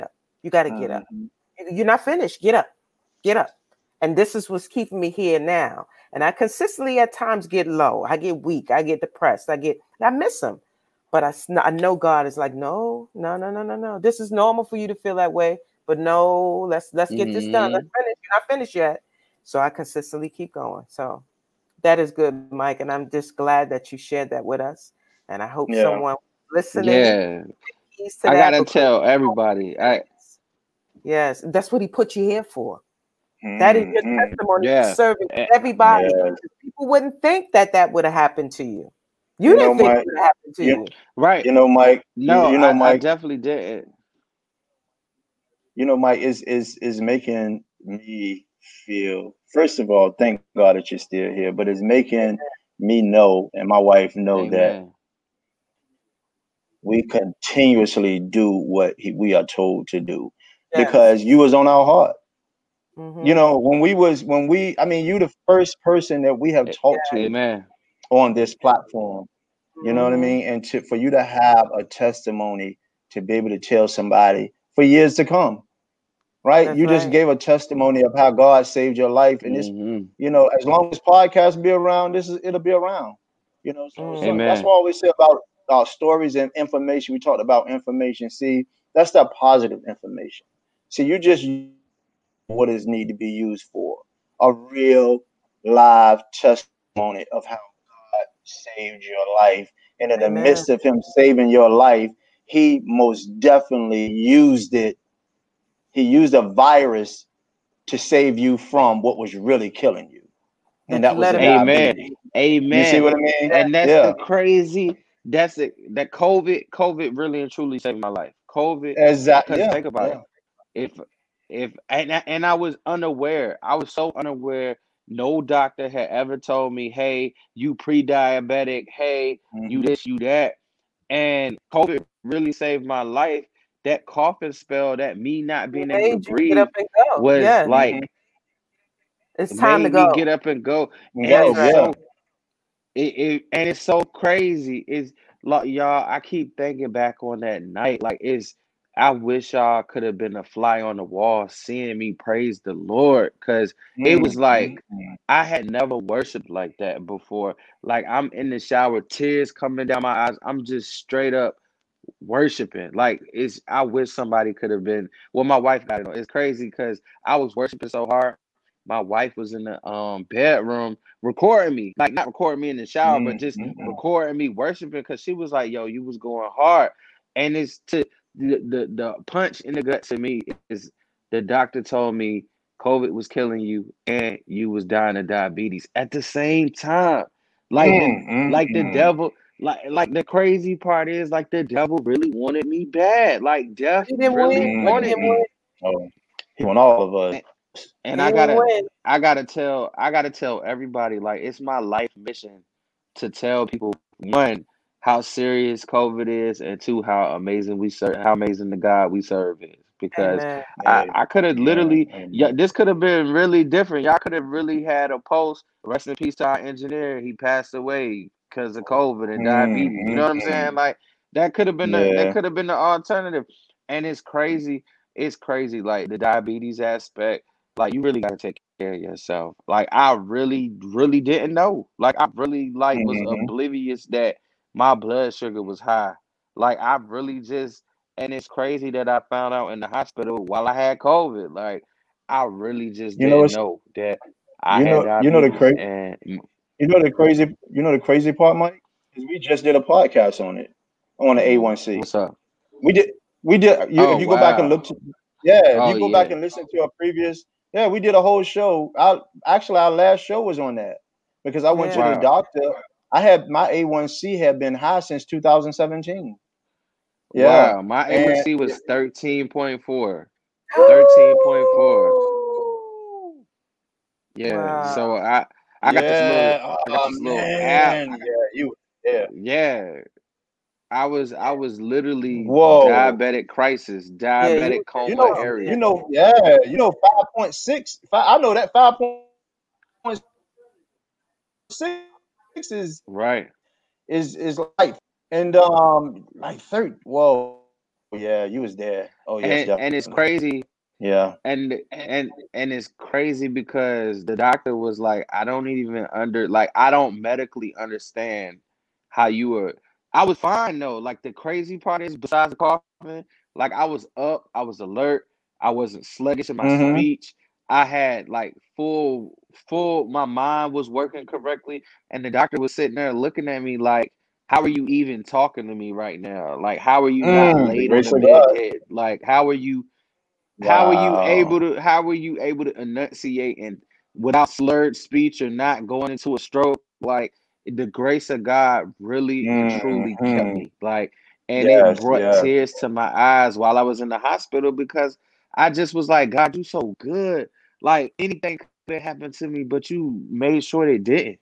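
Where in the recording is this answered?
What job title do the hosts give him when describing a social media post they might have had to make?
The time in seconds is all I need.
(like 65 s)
216 s.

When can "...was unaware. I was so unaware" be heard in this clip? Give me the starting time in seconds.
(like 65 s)
122 s.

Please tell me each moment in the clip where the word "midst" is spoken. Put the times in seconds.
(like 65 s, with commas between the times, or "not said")
100 s.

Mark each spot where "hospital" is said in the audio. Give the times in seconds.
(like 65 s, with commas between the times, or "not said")
239 s, 344 s.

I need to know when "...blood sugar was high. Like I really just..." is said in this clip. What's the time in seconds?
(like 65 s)
234 s.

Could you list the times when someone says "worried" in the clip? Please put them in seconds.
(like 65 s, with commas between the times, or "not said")
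not said.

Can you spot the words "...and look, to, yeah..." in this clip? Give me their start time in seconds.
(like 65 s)
254 s.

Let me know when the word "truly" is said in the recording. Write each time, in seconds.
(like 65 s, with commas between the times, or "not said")
117 s, 339 s.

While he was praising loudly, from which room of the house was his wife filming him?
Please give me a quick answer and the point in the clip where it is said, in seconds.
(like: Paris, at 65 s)
bedroom, at 170 s.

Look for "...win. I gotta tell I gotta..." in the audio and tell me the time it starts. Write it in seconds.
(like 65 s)
198 s.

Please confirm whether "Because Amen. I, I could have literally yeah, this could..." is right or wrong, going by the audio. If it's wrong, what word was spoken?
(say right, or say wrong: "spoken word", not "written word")
right.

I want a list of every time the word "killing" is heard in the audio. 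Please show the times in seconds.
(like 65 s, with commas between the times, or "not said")
109 s, 183 s.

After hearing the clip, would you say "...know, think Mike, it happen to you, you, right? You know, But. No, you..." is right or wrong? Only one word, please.
wrong.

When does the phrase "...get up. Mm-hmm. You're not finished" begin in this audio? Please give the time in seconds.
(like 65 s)
0 s.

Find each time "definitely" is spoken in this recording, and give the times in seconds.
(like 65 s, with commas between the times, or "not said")
42 s, 103 s.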